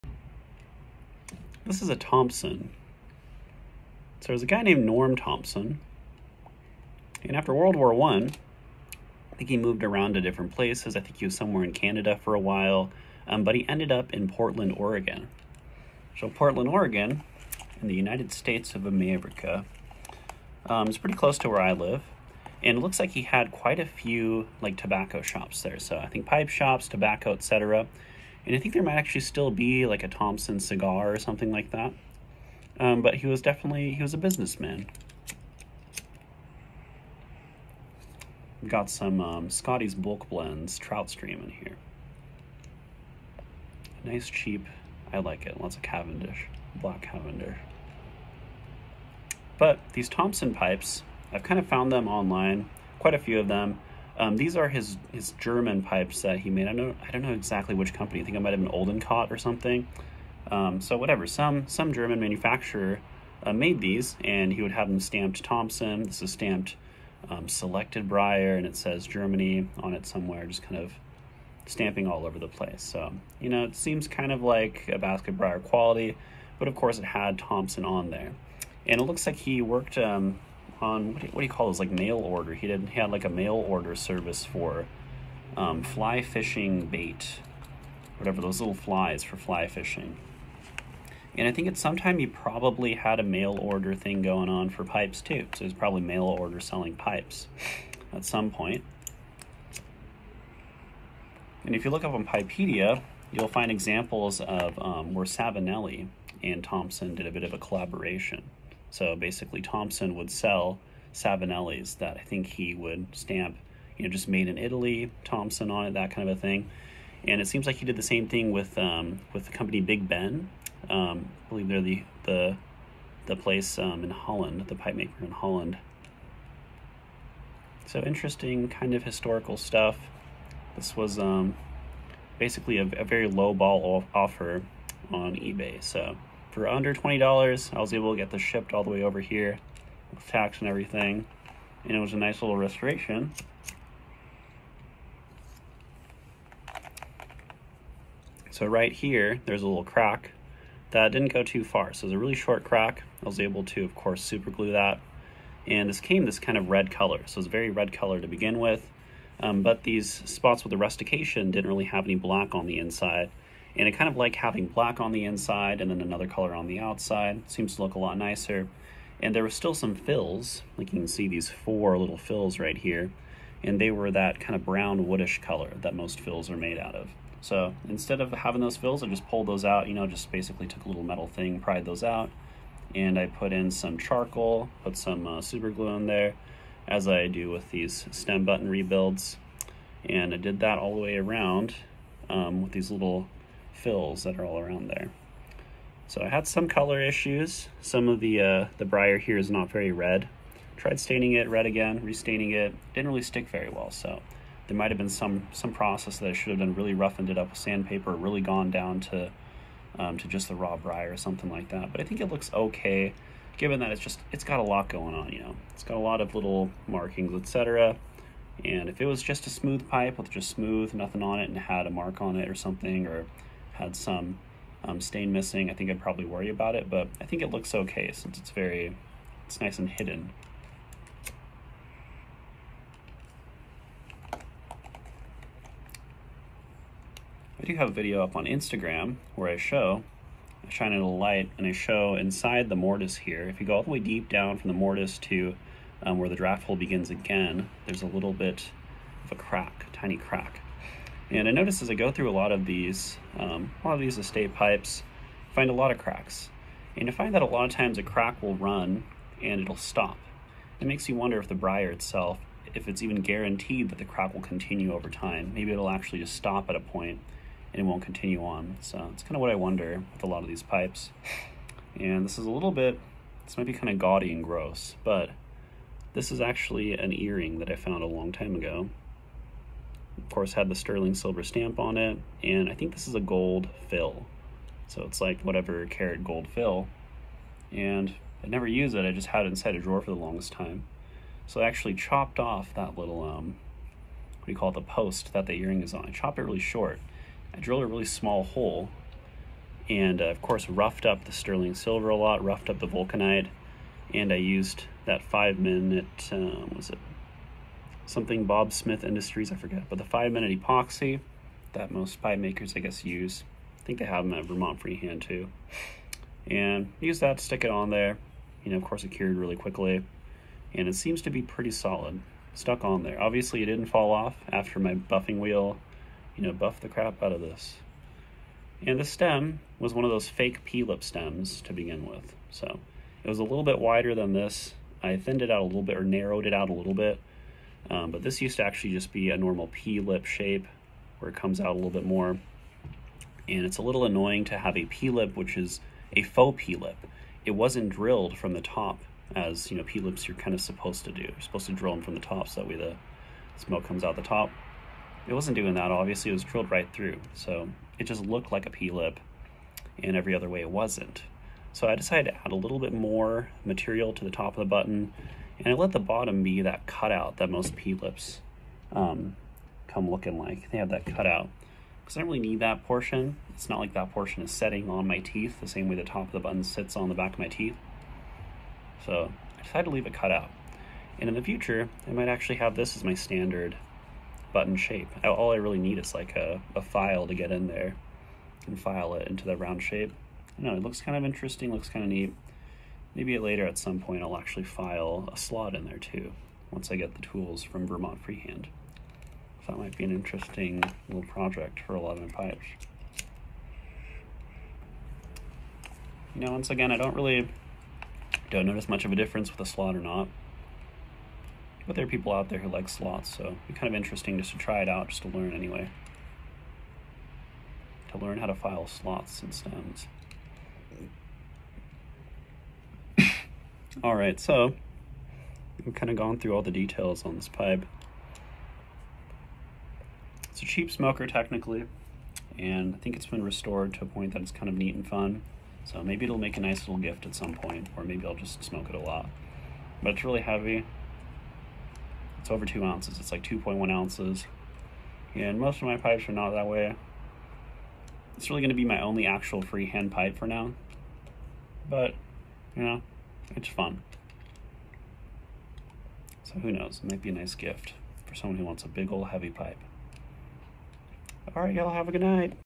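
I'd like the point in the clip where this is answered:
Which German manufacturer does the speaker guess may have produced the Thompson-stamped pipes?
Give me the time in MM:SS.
00:58.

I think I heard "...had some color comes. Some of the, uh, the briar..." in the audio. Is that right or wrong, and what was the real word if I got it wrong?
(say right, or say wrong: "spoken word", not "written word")
wrong: "issues", not "comes".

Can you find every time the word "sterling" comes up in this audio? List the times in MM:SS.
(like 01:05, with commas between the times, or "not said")
04:40, 05:01.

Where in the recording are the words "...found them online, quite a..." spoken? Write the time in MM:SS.
00:51.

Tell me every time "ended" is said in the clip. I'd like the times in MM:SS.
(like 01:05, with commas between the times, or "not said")
00:13.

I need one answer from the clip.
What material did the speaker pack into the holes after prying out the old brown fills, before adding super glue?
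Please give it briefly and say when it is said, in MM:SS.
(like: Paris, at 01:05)
charcoal, at 03:03.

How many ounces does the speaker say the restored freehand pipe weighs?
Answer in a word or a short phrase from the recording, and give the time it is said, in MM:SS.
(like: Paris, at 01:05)
2.1 ounces, at 07:23.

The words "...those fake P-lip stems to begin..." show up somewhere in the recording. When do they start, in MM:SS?
05:30.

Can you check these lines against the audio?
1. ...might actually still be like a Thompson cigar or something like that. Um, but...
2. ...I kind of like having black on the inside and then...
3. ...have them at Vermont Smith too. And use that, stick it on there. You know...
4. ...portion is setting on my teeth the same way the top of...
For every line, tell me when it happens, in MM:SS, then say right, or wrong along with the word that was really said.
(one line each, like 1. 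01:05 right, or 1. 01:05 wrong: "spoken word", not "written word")
1. 00:28 right
2. 02:43 right
3. 05:14 wrong: "Freehand", not "Smith"
4. 06:14 right.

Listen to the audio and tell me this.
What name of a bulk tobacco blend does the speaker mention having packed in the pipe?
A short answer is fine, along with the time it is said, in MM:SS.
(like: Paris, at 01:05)
Trout Stream, at 00:40.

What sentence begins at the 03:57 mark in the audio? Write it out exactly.
I do have a video up on Instagram where I show, I shine a light and I show inside the mortise here.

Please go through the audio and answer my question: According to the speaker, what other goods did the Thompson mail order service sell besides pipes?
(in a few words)
fly fishing bait.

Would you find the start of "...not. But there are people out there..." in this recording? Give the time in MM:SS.
06:49.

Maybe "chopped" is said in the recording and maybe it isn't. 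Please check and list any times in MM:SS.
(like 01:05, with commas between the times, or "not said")
04:51, 04:56.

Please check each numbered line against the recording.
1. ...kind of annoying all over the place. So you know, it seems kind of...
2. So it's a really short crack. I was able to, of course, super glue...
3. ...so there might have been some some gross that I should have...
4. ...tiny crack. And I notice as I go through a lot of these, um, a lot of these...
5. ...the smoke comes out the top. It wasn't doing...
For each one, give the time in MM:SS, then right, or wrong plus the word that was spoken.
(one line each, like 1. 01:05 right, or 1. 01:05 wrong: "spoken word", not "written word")
1. 01:10 wrong: "stamping", not "annoying"
2. 02:31 right
3. 03:23 wrong: "process", not "gross"
4. 04:09 right
5. 05:52 right.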